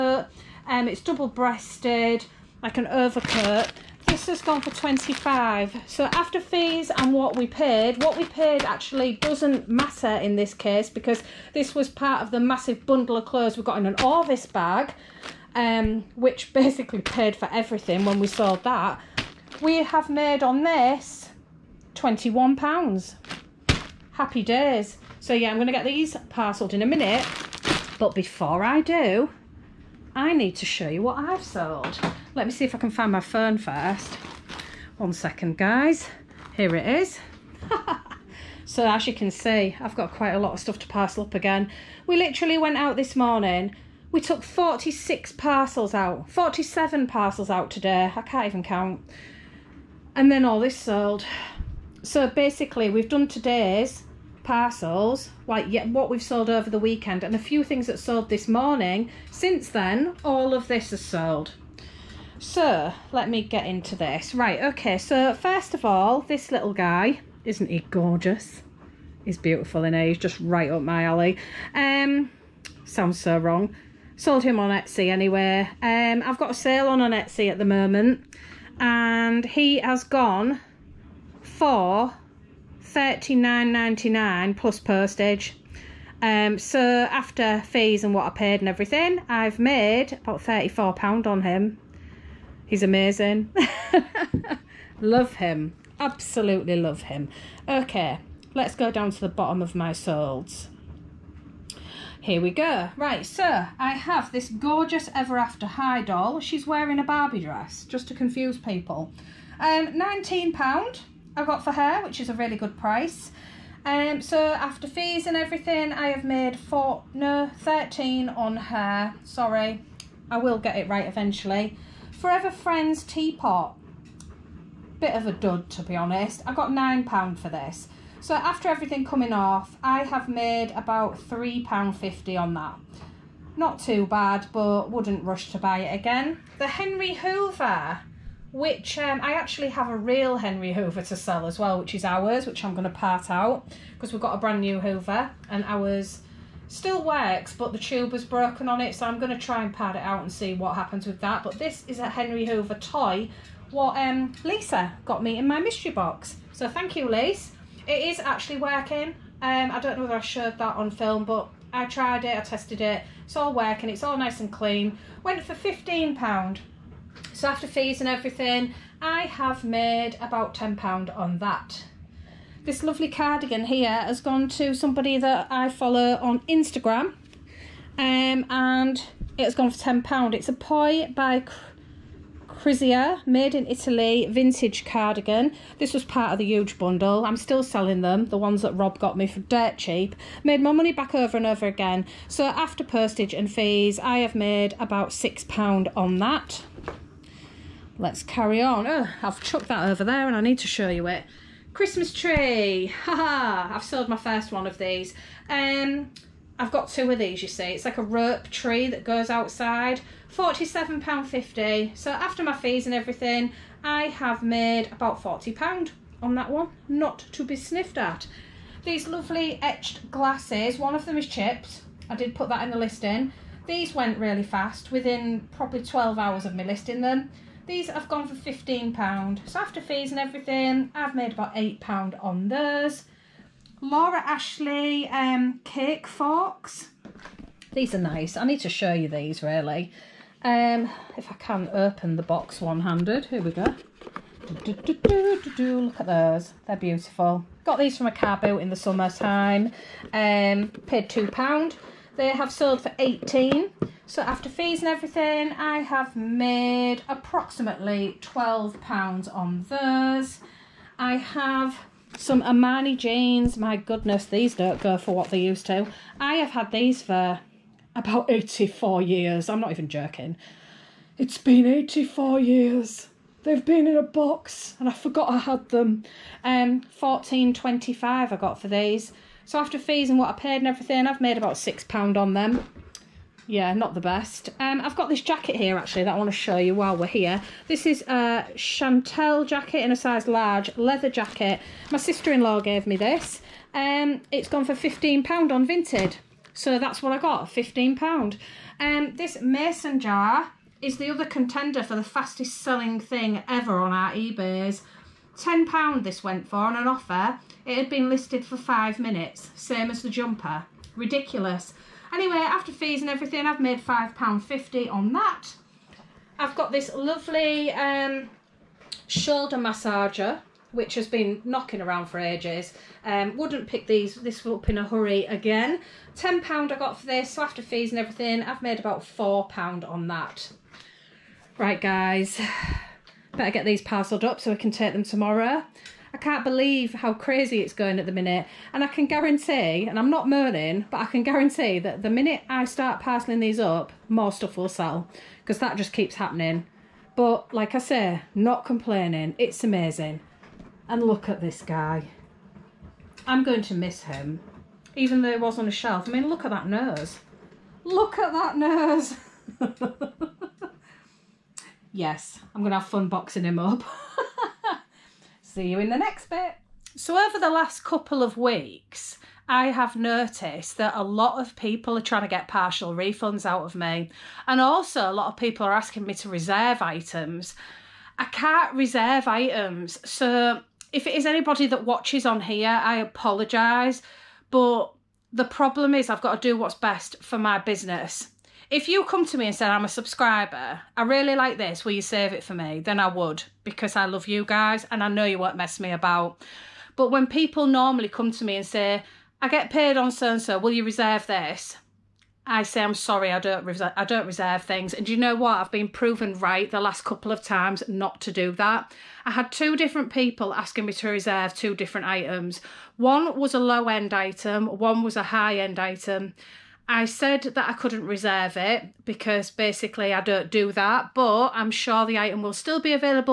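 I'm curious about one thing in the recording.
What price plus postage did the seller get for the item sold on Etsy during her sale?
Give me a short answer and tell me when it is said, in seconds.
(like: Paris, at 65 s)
£39.99, at 82 s.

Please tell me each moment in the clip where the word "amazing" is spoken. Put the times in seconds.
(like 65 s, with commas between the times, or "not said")
92 s, 349 s.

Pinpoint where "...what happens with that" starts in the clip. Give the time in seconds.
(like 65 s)
150 s.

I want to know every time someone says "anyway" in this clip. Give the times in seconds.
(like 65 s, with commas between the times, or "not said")
75 s, 312 s.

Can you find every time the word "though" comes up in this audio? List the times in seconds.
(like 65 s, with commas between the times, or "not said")
355 s.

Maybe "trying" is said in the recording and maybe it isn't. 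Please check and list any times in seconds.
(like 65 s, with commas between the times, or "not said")
372 s.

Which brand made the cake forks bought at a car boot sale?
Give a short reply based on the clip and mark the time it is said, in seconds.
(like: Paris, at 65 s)
Laura Ashley, at 233 s.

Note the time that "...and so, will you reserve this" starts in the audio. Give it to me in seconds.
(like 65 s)
400 s.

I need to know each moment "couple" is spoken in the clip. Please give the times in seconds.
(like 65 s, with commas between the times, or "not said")
367 s, 407 s.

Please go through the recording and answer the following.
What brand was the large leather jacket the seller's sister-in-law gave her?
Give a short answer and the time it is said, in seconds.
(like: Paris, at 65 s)
Chantel, at 288 s.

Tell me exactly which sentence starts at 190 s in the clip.
Made my money back over and over again.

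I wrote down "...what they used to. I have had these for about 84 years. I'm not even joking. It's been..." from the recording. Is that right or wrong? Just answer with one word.
right.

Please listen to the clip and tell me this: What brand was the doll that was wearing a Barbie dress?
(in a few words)
Ever After High.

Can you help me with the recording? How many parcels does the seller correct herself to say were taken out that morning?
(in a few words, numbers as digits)
47.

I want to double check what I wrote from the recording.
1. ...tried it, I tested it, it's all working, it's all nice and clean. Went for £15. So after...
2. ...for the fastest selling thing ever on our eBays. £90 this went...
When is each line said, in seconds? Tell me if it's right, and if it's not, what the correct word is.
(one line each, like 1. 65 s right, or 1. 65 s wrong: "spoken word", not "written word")
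1. 161 s right
2. 301 s wrong: "10", not "90".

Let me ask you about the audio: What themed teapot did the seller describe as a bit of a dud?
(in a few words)
Forever Friends.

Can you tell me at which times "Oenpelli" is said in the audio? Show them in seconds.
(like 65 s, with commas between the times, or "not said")
not said.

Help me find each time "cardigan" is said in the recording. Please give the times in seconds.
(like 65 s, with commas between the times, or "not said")
173 s, 184 s.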